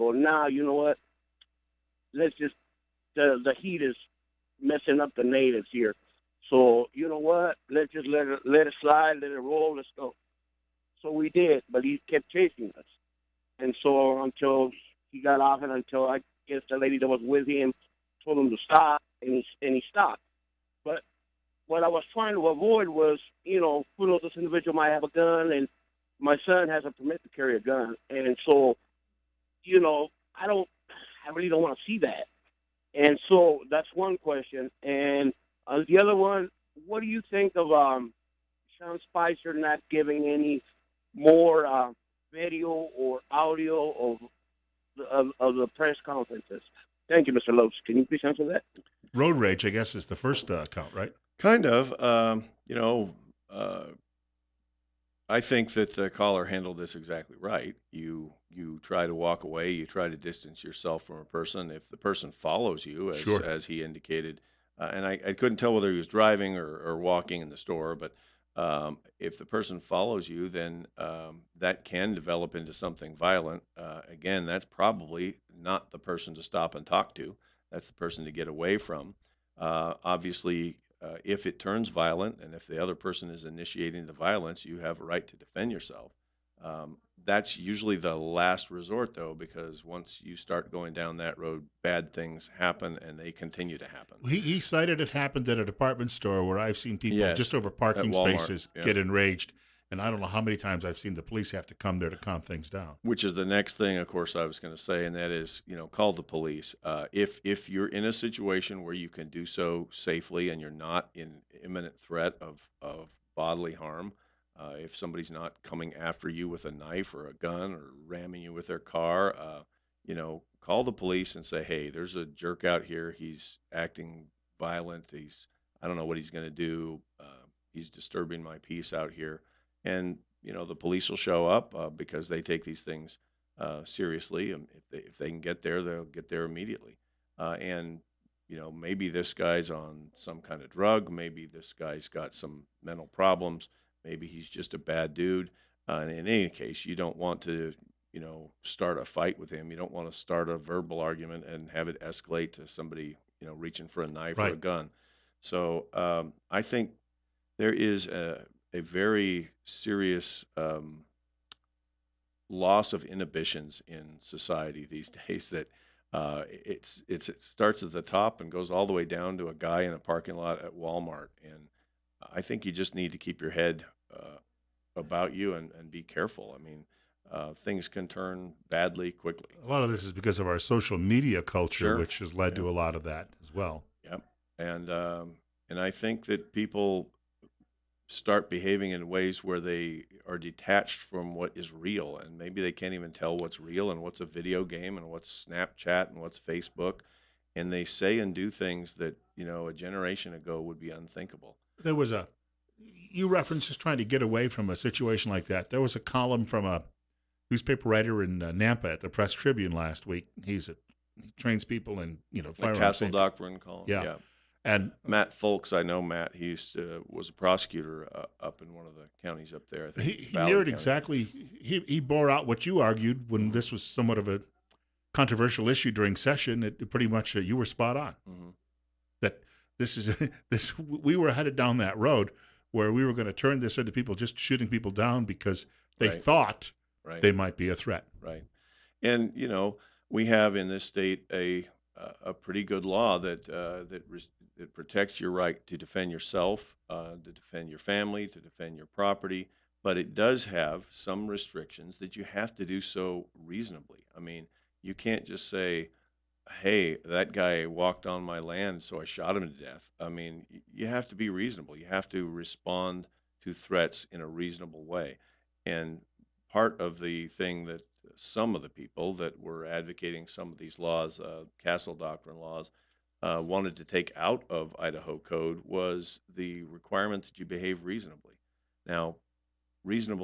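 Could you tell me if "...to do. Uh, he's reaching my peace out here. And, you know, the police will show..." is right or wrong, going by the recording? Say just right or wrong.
wrong.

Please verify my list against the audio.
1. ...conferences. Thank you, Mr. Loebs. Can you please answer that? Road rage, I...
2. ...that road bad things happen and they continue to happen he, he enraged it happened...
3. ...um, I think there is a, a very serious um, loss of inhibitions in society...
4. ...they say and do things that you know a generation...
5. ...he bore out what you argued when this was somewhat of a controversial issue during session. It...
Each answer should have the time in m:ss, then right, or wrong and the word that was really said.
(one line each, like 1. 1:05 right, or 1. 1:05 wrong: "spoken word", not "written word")
1. 0:46 right
2. 1:31 wrong: "cited", not "enraged"
3. 2:35 right
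4. 3:17 right
5. 3:41 right.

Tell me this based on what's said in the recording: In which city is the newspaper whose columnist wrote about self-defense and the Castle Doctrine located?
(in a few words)
Nampa.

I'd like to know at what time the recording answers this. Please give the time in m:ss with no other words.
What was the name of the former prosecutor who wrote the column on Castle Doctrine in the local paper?
3:35.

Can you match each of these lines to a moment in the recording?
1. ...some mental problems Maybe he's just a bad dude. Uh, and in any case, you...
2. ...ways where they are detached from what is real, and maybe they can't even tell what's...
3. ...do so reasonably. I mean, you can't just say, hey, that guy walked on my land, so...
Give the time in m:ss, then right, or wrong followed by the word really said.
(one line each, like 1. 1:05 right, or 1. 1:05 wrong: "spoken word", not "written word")
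1. 2:22 right
2. 3:09 right
3. 4:12 right.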